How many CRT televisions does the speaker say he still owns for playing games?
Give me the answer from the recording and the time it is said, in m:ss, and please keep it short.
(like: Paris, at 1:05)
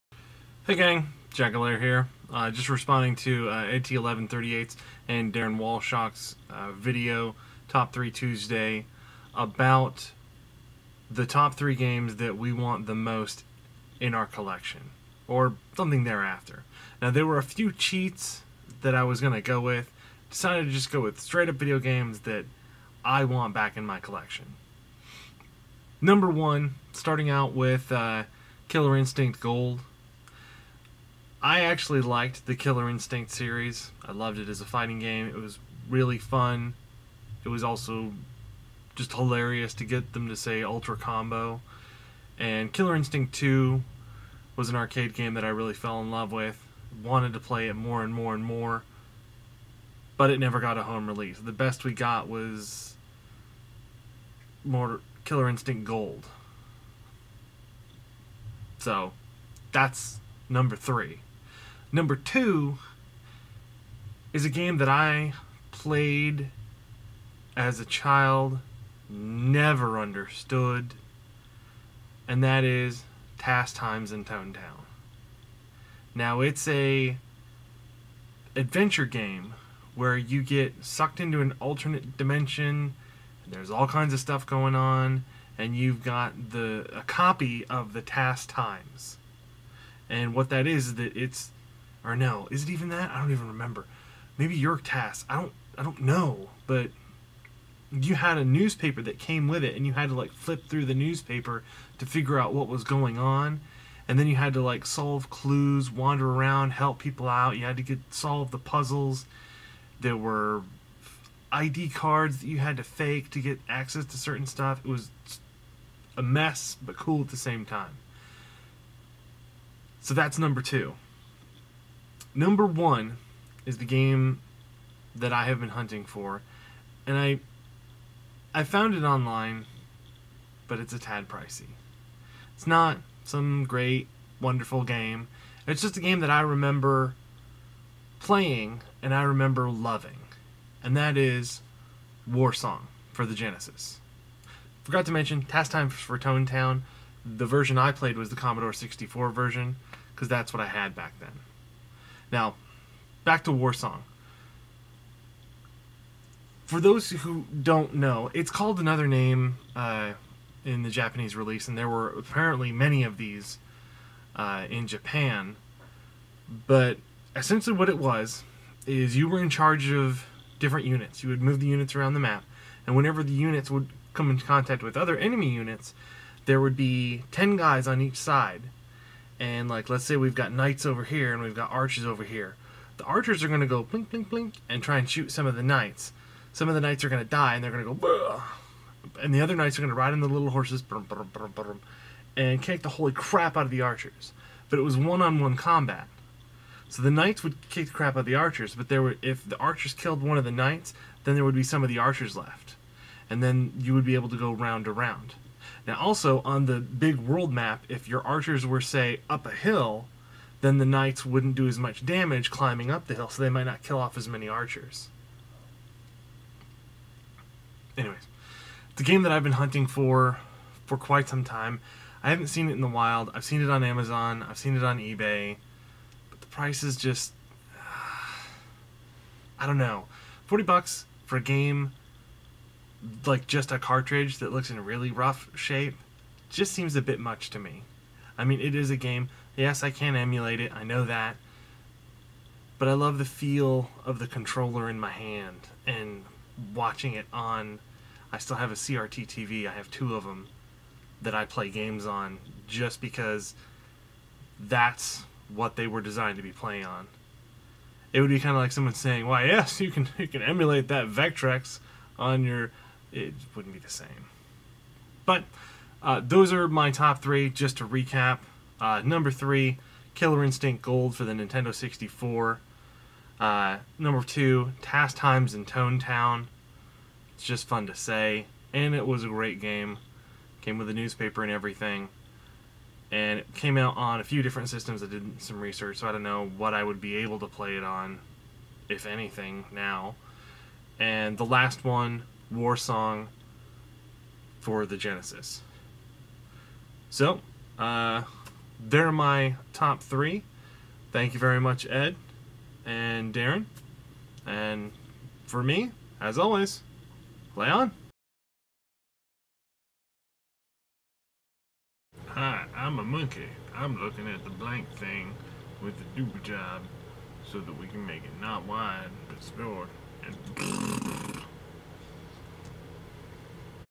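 2, at 4:09.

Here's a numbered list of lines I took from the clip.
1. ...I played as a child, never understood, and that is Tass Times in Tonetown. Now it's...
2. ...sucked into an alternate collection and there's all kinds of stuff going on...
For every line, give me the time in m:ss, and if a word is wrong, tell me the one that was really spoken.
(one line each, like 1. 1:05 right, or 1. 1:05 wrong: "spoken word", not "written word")
1. 1:04 right
2. 1:20 wrong: "dimension", not "collection".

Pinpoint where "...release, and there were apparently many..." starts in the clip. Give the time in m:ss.
2:41.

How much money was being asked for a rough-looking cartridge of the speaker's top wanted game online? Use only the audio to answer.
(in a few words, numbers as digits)
$40.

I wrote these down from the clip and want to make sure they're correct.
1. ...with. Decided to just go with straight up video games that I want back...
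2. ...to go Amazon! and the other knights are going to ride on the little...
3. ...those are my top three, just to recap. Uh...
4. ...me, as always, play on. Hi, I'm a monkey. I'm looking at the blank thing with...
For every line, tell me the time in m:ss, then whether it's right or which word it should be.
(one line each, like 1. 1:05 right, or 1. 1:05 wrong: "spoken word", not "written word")
1. 0:19 right
2. 3:07 wrong: "Bleh", not "Amazon"
3. 4:26 right
4. 5:05 right.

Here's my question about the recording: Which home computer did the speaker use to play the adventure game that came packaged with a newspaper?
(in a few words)
Commodore 64.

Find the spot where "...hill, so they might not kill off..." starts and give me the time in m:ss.
3:33.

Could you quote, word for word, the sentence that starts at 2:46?
But essentially, what it was is you were in charge of different units.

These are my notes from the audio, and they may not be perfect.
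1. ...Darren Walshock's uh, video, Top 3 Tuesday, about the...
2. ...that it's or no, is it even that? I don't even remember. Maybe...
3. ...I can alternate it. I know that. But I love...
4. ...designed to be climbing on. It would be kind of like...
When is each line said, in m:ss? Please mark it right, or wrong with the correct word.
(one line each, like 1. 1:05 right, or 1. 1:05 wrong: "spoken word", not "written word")
1. 0:05 right
2. 1:30 right
3. 3:59 wrong: "emulate", not "alternate"
4. 4:16 wrong: "playing", not "climbing".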